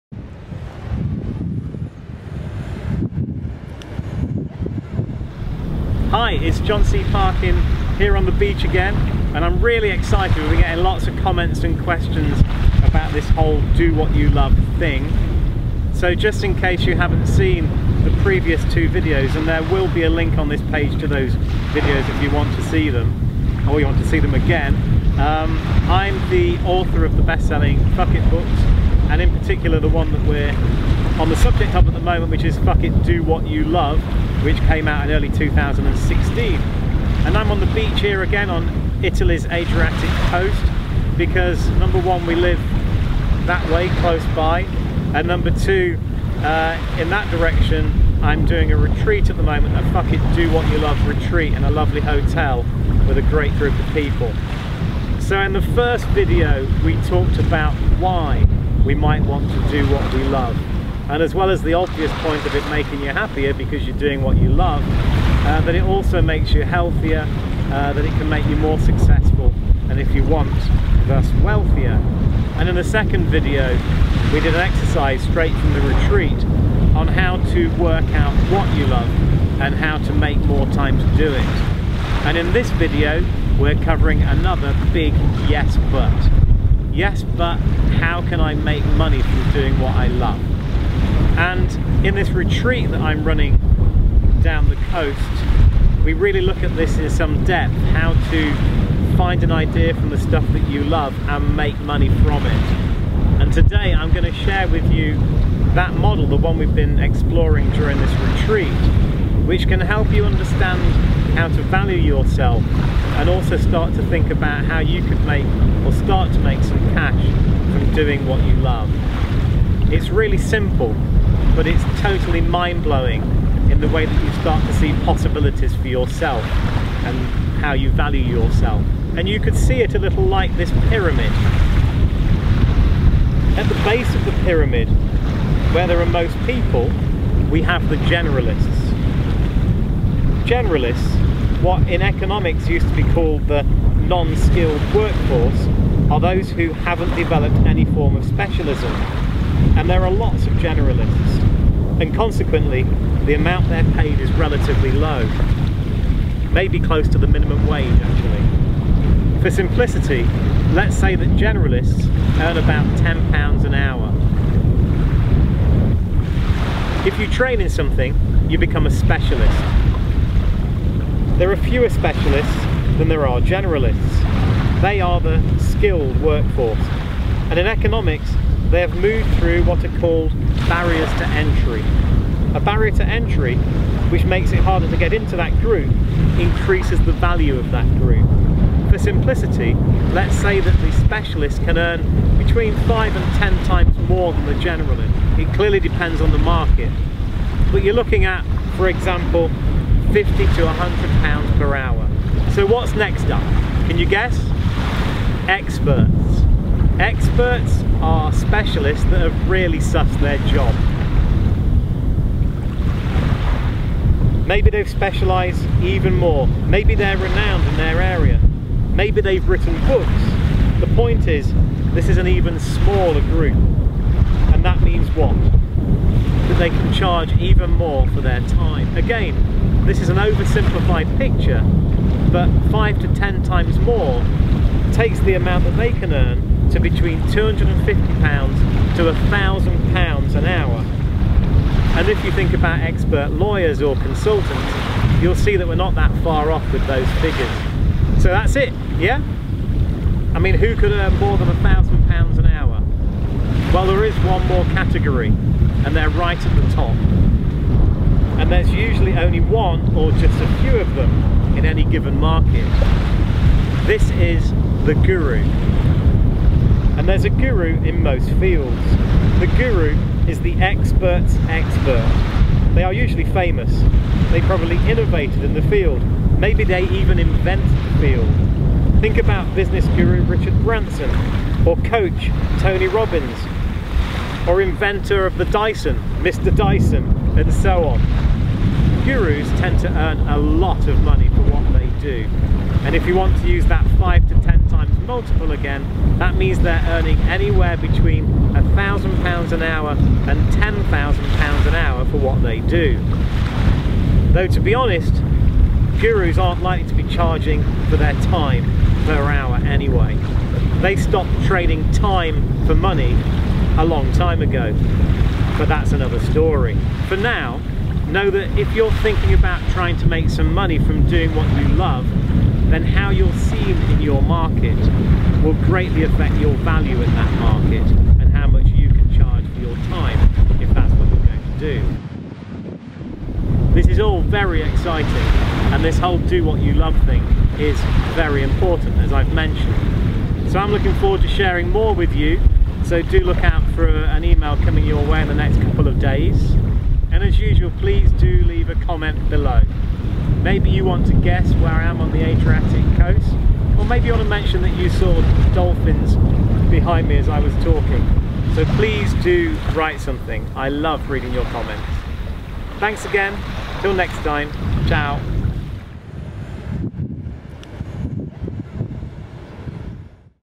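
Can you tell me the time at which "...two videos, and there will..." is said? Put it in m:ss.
0:18.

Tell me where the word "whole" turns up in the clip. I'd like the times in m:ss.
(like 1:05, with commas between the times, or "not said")
0:13, 5:35.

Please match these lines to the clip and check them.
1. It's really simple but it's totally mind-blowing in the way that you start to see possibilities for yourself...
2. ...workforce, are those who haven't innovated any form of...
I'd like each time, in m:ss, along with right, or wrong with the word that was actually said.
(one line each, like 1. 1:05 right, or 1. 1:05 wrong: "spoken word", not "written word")
1. 1:59 right
2. 2:24 wrong: "developed", not "innovated".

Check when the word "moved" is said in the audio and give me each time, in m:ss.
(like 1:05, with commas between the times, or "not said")
2:58.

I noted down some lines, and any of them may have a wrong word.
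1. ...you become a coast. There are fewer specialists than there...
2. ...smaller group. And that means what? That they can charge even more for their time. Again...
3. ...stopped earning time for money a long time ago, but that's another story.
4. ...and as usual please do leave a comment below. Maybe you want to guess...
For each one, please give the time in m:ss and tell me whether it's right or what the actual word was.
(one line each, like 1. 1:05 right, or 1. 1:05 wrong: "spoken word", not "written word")
1. 2:48 wrong: "specialist", not "coast"
2. 3:42 right
3. 5:10 wrong: "trading", not "earning"
4. 5:47 right.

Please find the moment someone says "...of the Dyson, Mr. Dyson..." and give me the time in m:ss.
4:45.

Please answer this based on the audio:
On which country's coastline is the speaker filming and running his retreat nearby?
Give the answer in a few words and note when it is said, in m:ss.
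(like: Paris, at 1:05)
Italy, at 0:39.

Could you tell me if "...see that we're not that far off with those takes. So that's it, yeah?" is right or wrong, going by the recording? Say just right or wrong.
wrong.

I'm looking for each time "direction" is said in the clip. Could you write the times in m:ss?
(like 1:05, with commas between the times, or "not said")
0:47.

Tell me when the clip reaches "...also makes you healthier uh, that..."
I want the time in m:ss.
1:05.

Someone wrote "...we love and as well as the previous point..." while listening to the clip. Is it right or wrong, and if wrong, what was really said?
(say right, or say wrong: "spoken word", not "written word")
wrong: "obvious", not "previous".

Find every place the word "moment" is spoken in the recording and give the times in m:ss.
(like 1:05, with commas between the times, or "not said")
0:31, 0:49.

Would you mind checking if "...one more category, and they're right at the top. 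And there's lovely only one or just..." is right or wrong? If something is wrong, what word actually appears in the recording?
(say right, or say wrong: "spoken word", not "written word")
wrong: "usually", not "lovely".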